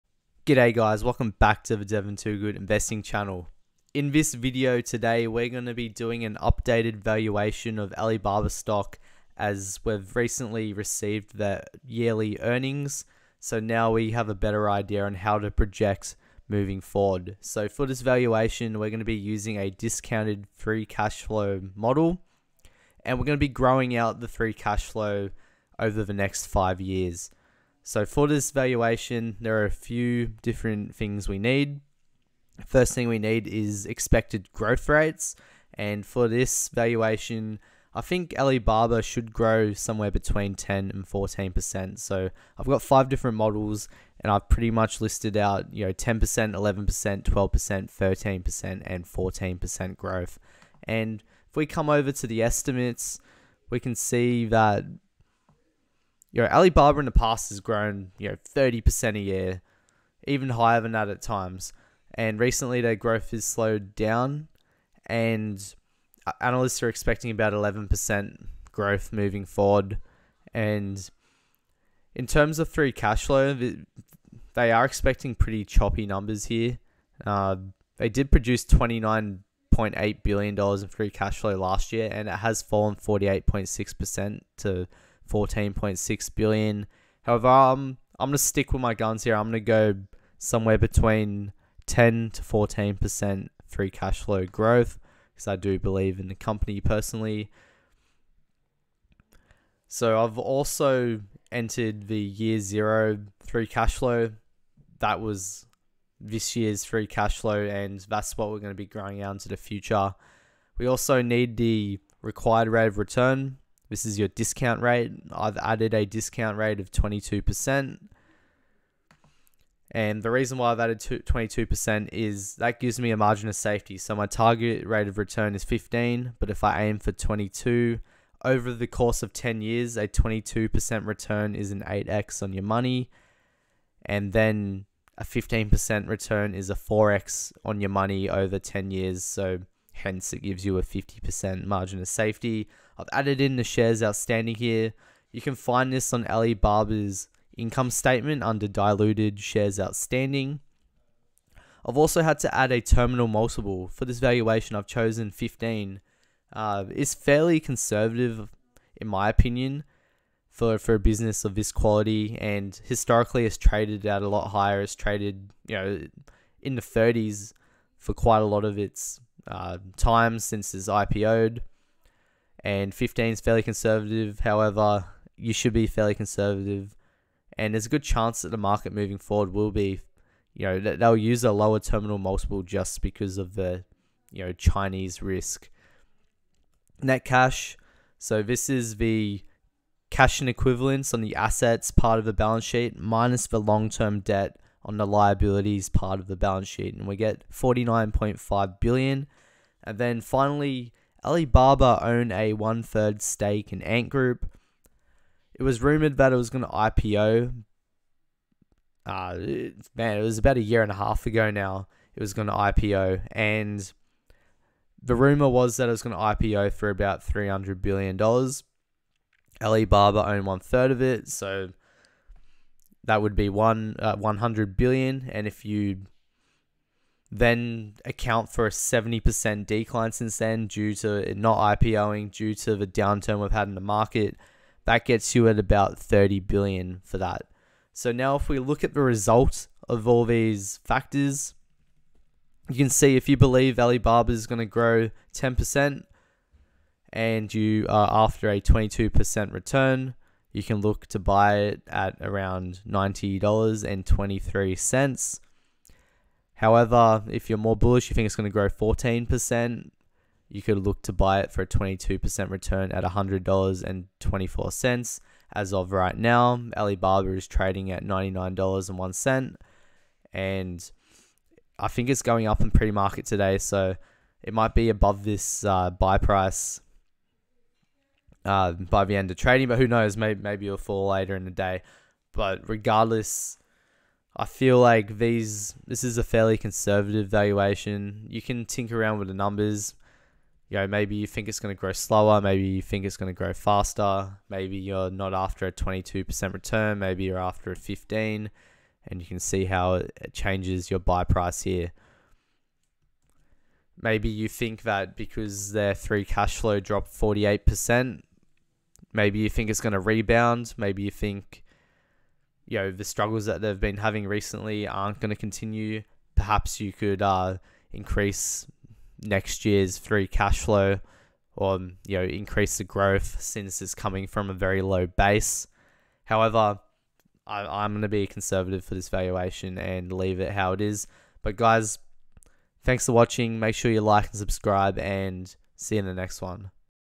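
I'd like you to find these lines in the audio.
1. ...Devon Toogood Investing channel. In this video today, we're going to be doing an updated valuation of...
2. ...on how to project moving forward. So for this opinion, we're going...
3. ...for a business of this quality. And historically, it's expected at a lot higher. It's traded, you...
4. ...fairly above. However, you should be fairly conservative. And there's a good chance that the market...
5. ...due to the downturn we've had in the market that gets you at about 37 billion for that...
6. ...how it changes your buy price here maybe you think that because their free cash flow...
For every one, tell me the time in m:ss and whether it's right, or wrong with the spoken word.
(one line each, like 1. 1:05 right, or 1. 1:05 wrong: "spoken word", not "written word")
1. 0:01 right
2. 0:15 wrong: "valuation", not "opinion"
3. 2:40 wrong: "traded", not "expected"
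4. 2:53 wrong: "conservative", not "above"
5. 3:52 wrong: "30", not "37"
6. 4:59 right.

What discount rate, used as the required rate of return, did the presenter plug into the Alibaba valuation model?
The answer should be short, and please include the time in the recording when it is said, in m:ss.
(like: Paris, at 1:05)
22%, at 1:55.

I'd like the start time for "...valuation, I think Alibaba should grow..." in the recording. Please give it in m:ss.
0:36.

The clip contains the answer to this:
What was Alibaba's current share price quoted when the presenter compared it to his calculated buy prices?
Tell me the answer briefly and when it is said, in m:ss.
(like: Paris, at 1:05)
$99.01, at 4:28.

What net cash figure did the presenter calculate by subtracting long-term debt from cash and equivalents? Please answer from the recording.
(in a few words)
49.5 billion.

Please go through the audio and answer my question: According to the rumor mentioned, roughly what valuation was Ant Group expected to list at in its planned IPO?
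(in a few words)
$300 billion.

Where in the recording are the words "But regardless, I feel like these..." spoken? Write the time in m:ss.
4:42.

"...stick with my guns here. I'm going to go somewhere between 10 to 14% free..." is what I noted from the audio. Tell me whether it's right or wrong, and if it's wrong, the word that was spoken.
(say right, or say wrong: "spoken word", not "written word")
right.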